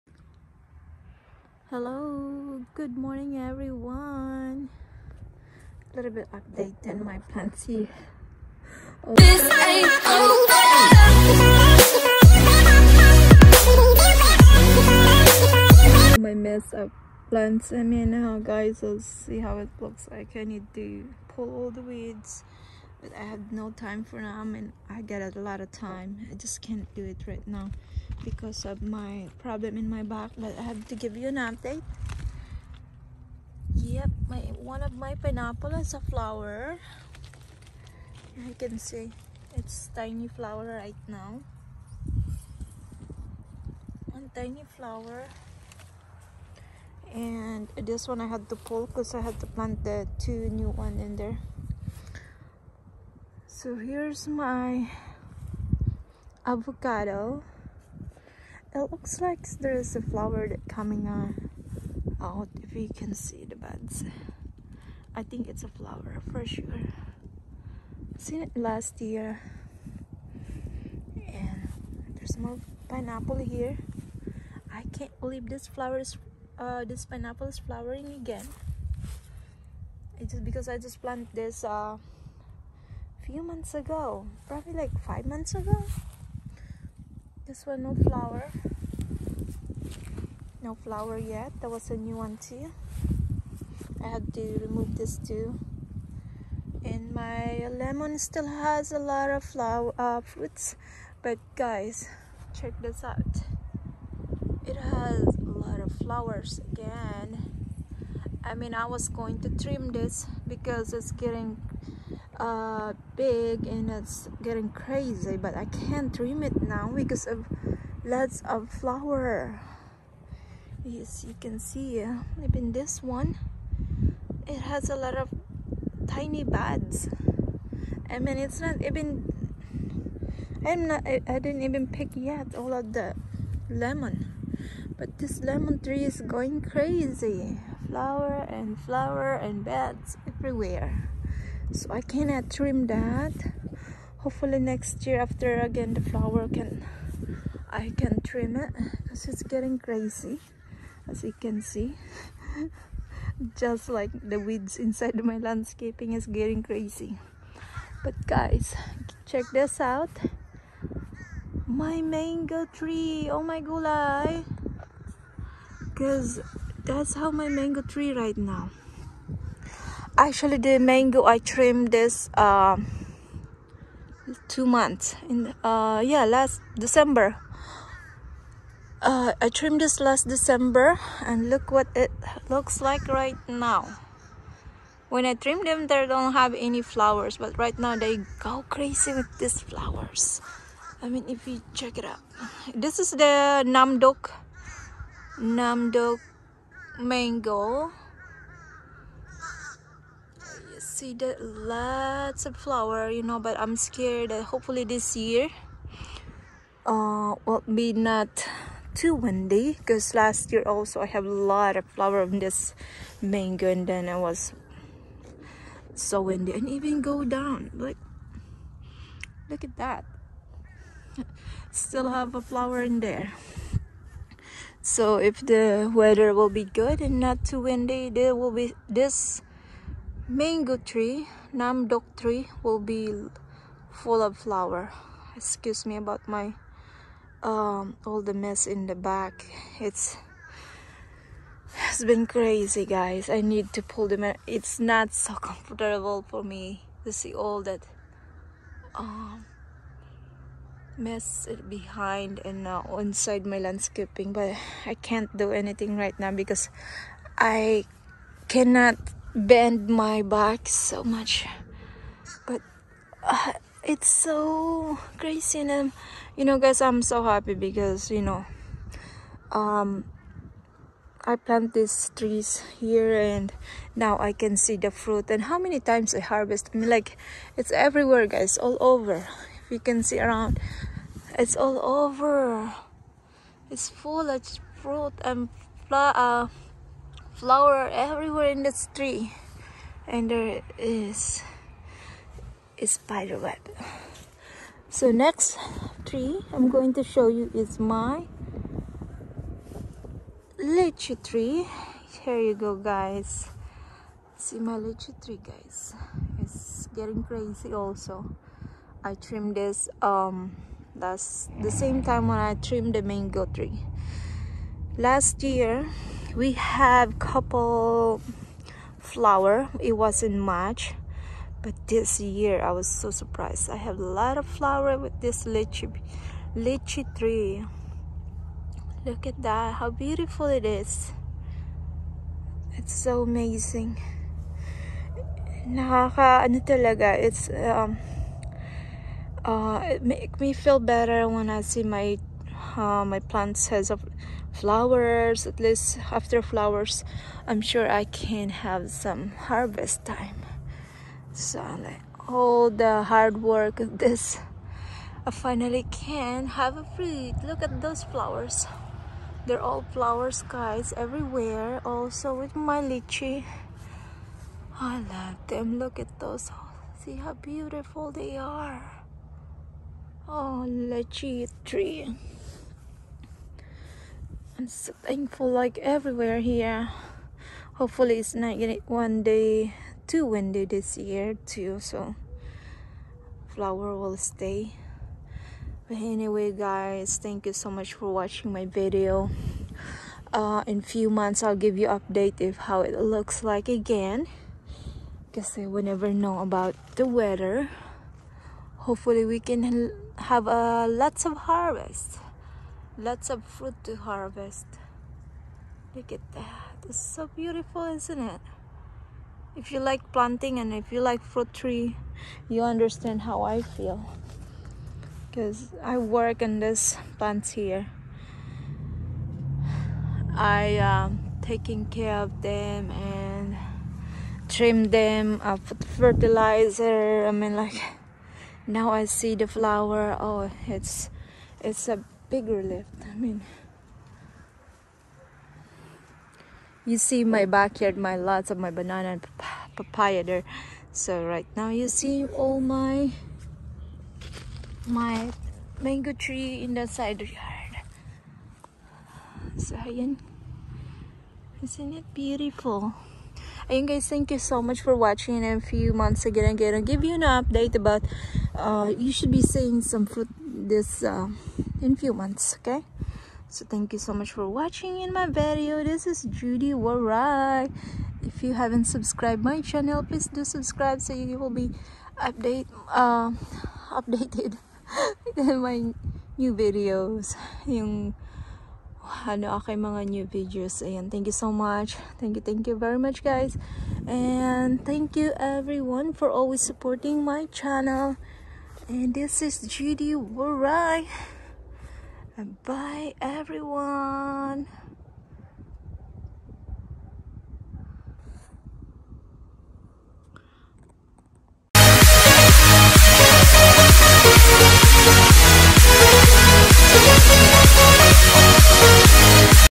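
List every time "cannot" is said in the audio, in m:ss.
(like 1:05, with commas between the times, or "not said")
2:22, 4:18.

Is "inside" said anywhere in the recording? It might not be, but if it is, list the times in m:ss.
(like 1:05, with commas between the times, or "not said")
2:34, 4:12.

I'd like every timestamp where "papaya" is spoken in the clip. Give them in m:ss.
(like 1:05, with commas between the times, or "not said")
7:19.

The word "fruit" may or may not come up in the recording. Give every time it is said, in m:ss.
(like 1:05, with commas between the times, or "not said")
1:40, 4:34, 4:44, 5:56, 6:43, 6:51, 7:40.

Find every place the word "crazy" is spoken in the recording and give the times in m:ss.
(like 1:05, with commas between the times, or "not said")
1:54, 2:16, 2:29, 2:36, 3:08, 4:02, 4:25, 5:07.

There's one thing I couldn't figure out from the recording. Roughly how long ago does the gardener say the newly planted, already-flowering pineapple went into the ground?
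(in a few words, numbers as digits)
5 months.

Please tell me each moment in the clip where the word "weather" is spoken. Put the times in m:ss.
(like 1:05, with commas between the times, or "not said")
3:45, 6:37.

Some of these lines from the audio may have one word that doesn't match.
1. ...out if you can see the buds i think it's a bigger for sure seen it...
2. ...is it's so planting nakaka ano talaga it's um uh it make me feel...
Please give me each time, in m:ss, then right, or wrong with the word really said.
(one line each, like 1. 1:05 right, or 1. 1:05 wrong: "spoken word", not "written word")
1. 1:02 wrong: "flower", not "bigger"
2. 5:30 wrong: "amazing", not "planting".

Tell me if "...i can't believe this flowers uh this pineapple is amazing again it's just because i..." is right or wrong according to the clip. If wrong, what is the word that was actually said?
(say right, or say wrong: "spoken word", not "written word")
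wrong: "flowering", not "amazing".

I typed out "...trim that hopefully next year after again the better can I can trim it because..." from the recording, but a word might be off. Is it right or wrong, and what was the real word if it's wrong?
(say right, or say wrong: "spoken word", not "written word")
wrong: "flower", not "better".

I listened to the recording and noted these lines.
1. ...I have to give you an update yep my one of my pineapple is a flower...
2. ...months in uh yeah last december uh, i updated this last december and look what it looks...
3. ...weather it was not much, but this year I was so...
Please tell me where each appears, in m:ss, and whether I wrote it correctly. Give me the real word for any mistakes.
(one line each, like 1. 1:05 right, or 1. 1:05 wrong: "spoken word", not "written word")
1. 0:30 right
2. 2:54 wrong: "trimmed", not "updated"
3. 5:18 wrong: "flower", not "weather".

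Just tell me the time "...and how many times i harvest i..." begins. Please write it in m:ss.
4:35.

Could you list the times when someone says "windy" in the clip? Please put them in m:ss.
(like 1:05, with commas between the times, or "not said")
3:29, 3:36, 3:47, 6:20.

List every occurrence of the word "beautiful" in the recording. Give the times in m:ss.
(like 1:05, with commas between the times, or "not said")
5:29, 6:07, 6:47, 7:32.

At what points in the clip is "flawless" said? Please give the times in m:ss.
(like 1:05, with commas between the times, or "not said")
not said.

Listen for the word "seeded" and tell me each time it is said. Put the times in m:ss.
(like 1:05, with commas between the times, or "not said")
3:21.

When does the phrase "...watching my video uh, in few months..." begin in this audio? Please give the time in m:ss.
6:28.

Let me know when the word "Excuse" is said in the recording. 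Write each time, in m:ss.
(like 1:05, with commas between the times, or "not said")
3:55.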